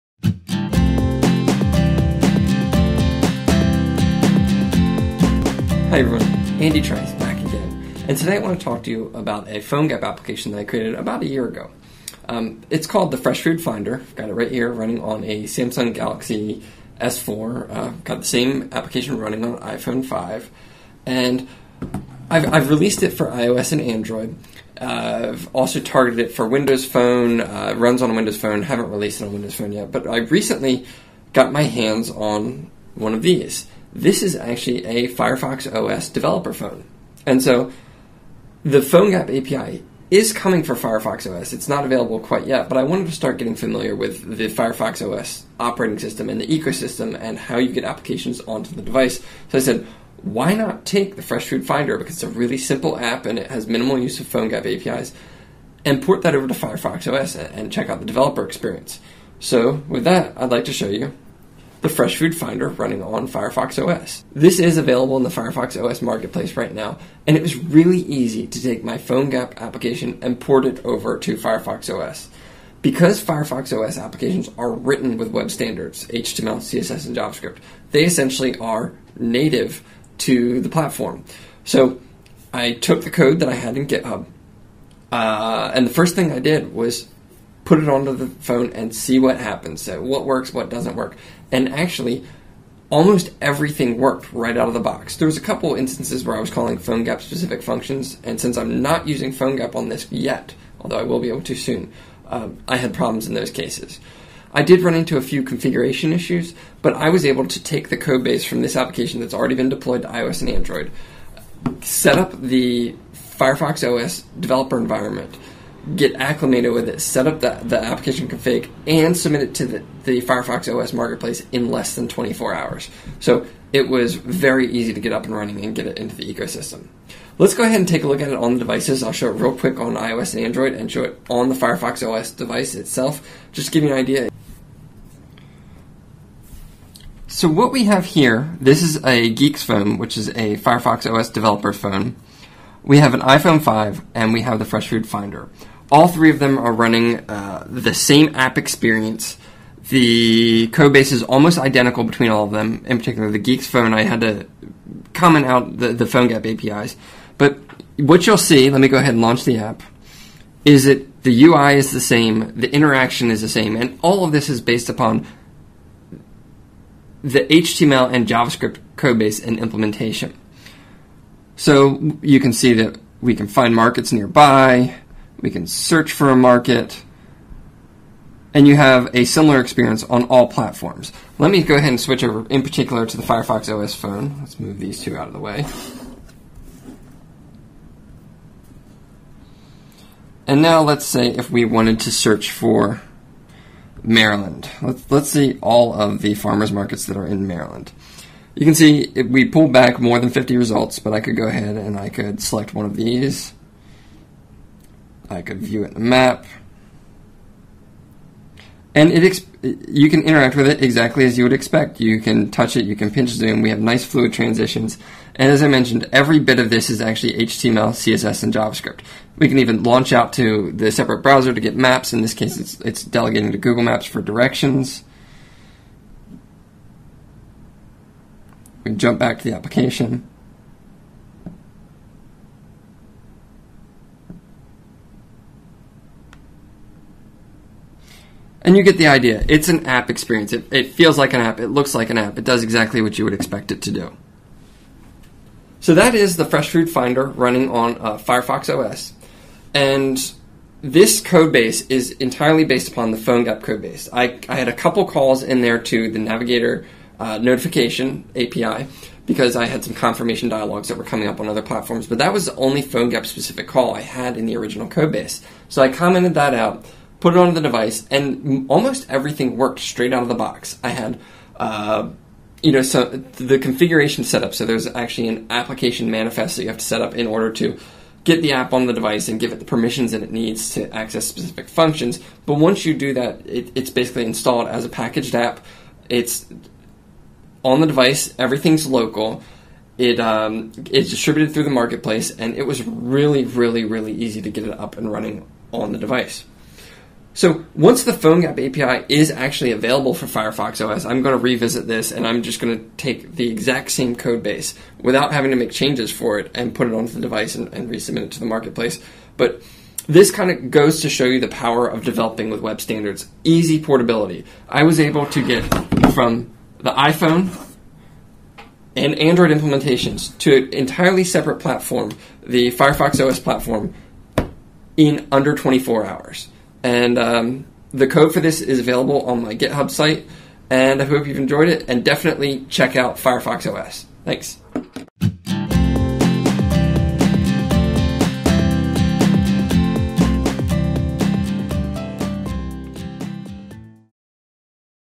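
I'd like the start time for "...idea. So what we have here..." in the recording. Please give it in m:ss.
2:13.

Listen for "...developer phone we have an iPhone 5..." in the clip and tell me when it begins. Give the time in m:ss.
2:21.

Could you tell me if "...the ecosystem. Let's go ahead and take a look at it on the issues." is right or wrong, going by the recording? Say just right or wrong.
wrong.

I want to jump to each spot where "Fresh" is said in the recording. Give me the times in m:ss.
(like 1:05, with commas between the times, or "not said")
0:13, 0:51, 1:01, 2:24, 4:06.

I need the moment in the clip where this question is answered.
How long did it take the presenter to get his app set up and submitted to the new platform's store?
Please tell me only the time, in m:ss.
2:01.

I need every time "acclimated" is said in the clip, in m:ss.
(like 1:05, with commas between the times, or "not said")
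1:56.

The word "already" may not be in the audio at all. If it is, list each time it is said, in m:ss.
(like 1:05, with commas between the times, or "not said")
1:49.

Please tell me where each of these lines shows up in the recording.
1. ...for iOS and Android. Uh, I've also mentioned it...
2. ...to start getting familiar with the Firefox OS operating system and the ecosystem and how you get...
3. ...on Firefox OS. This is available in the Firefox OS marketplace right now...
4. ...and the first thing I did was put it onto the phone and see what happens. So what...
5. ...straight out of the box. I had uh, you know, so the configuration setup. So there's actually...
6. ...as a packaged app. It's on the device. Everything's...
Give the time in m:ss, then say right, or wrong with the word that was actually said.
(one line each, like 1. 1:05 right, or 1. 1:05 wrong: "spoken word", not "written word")
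1. 0:23 wrong: "targeted", not "mentioned"
2. 0:43 right
3. 1:03 right
4. 1:25 right
5. 4:29 right
6. 4:44 right.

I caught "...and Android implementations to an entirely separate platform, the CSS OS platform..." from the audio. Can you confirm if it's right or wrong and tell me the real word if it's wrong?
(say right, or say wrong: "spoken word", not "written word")
wrong: "Firefox", not "CSS".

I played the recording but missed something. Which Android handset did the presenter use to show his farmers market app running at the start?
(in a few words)
Samsung Galaxy S4.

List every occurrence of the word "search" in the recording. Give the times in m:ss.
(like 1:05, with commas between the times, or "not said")
2:55, 3:12.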